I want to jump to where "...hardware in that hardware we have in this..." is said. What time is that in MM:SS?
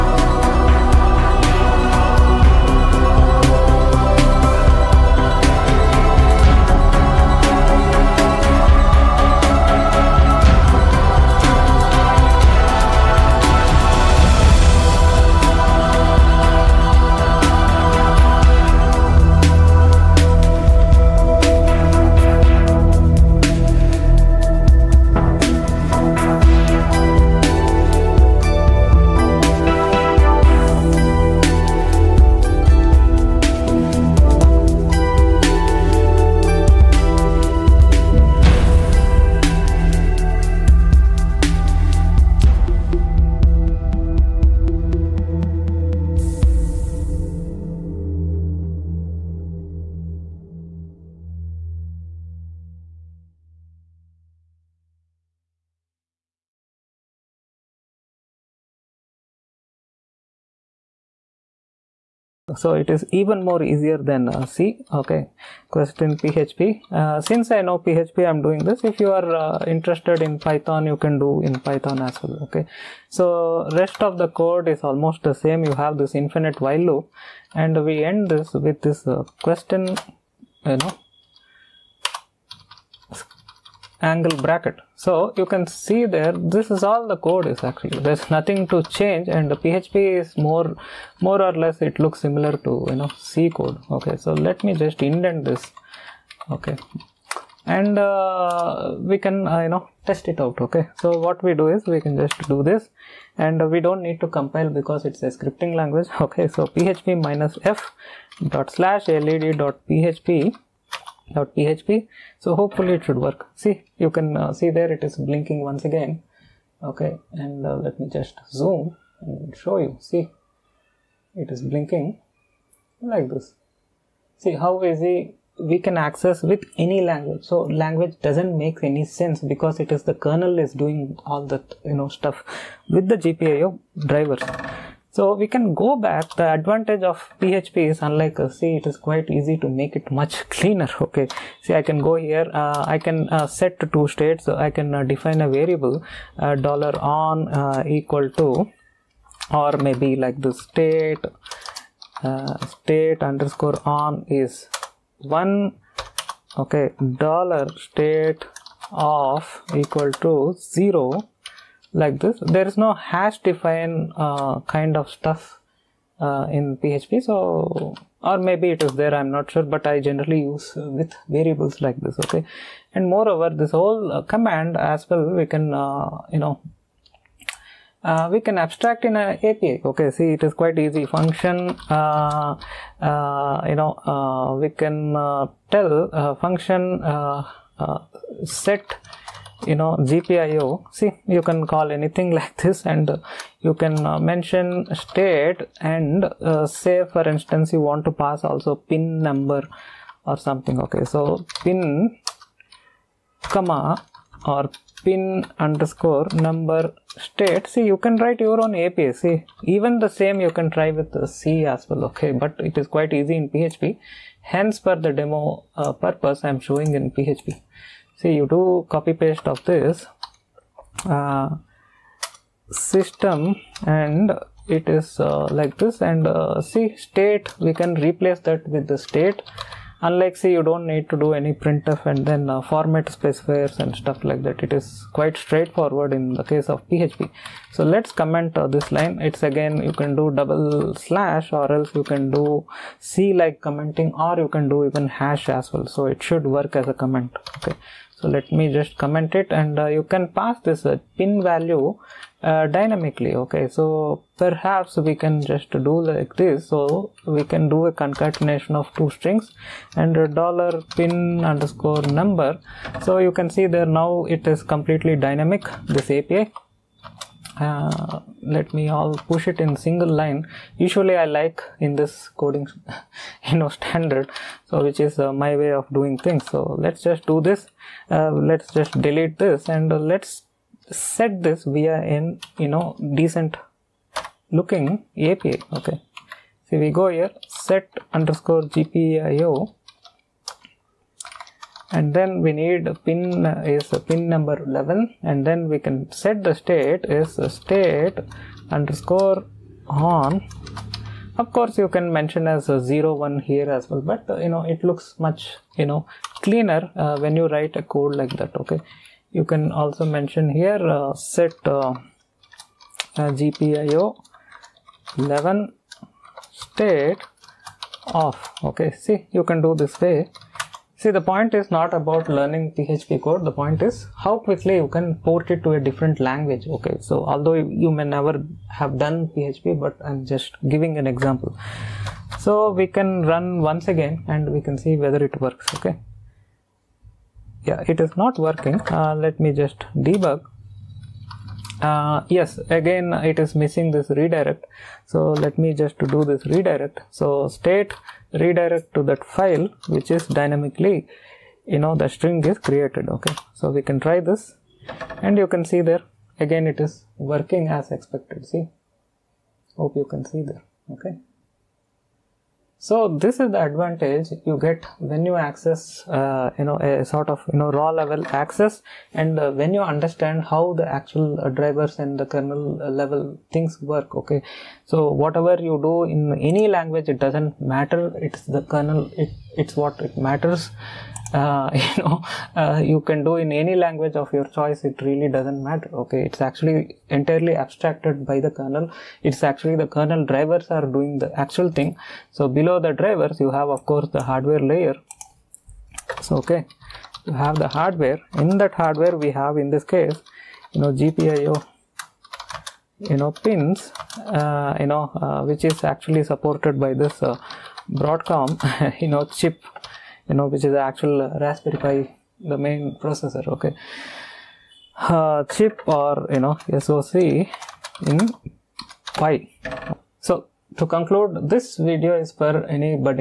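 06:37.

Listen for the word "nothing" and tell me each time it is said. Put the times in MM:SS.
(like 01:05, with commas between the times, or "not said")
01:28.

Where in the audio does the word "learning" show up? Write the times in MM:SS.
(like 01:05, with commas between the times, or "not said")
05:22.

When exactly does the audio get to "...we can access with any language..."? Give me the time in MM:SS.
02:05.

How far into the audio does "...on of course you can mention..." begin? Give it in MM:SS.
04:59.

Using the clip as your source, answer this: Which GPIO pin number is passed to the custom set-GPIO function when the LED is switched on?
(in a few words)
11.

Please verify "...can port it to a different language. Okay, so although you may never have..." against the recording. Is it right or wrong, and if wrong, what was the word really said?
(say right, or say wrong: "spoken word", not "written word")
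right.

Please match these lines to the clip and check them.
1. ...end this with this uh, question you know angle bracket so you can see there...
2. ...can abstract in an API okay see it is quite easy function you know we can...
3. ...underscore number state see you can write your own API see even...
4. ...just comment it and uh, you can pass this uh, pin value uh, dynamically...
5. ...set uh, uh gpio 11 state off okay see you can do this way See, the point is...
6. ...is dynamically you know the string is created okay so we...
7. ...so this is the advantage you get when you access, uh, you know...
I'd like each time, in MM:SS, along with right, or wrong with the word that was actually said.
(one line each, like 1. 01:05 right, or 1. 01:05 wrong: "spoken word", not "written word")
1. 01:18 right
2. 02:58 right
3. 03:25 right
4. 04:08 right
5. 05:11 right
6. 05:50 right
7. 06:02 right.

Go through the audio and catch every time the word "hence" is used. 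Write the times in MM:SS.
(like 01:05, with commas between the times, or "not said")
03:34.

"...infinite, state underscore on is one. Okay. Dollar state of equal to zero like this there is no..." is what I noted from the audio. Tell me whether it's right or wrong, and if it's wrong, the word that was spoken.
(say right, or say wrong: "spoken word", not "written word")
wrong: "state", not "infinite".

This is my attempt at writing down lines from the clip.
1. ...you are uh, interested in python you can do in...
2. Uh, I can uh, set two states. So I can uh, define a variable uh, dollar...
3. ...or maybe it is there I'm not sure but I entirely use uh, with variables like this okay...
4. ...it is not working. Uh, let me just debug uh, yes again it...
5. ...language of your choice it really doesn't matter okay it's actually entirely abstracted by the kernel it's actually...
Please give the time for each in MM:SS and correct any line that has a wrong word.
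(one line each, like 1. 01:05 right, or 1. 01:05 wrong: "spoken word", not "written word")
1. 01:08 right
2. 02:22 right
3. 02:48 wrong: "generally", not "entirely"
4. 05:37 right
5. 06:23 right.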